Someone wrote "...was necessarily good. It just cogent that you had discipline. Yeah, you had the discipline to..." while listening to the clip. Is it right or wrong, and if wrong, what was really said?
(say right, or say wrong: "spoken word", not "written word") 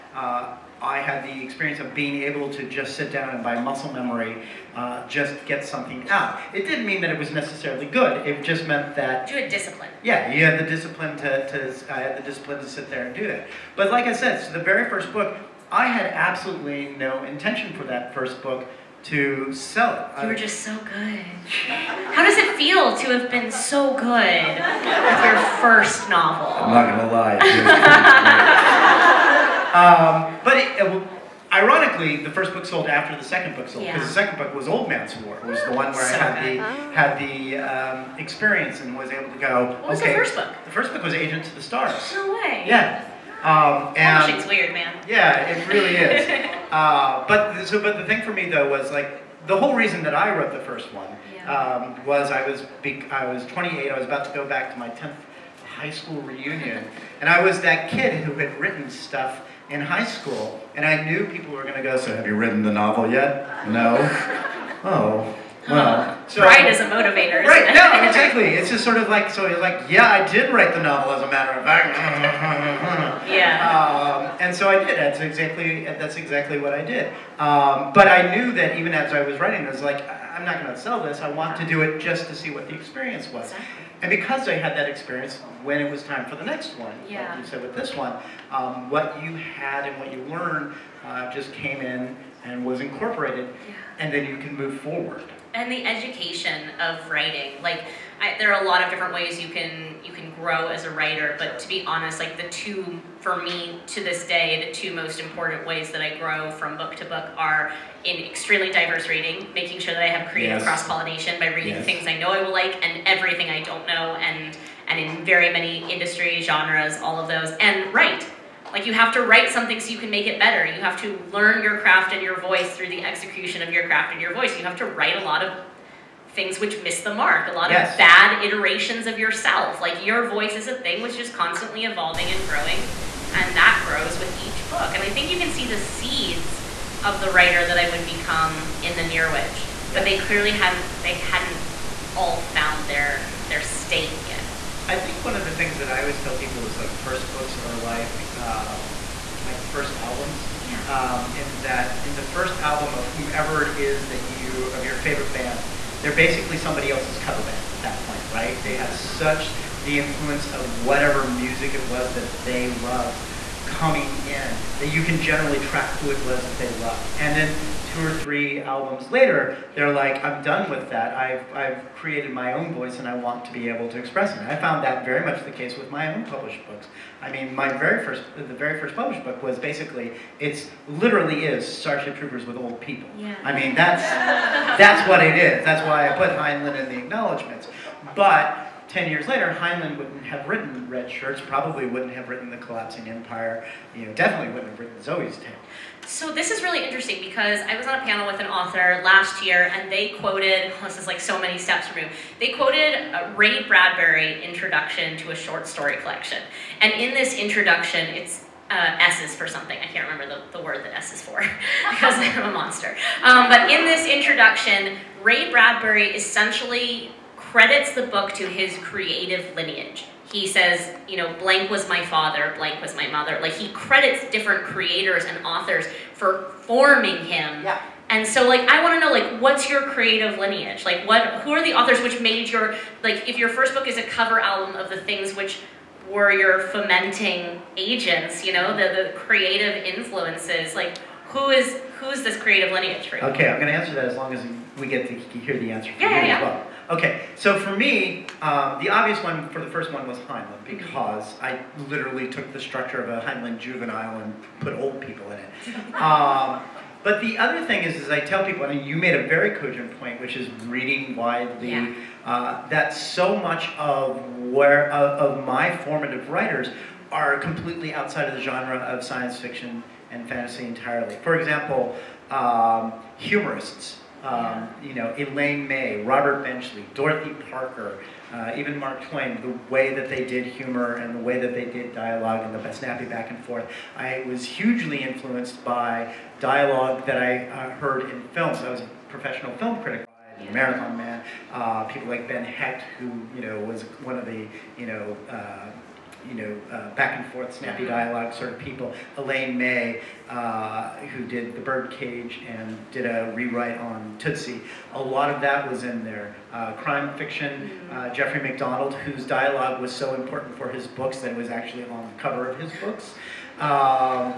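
wrong: "meant", not "cogent".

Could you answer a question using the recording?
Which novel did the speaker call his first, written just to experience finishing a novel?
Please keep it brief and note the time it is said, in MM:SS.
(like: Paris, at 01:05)
Agent to the Stars, at 00:41.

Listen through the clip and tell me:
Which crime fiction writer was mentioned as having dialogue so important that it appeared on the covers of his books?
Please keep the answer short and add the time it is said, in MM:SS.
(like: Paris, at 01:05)
Gregory Mcdonald, at 05:08.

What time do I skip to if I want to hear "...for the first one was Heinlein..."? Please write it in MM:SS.
04:09.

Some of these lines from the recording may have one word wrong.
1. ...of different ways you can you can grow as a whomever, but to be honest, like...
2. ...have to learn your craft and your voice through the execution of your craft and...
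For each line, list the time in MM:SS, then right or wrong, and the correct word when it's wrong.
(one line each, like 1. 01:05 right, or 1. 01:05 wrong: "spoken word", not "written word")
1. 01:38 wrong: "writer", not "whomever"
2. 02:00 right.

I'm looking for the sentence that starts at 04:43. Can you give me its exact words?
I was hugely influenced by dialogue that I uh, heard in films.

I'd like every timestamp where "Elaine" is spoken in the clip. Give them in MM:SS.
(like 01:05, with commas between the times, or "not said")
04:35, 04:59.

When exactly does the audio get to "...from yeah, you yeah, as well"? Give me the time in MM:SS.
04:05.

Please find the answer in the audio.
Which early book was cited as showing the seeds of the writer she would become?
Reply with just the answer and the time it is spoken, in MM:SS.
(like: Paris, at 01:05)
The Near Witch, at 02:19.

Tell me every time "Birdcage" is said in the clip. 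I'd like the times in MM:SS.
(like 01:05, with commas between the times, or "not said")
05:01.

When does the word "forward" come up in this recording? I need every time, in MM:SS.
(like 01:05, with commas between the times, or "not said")
01:34.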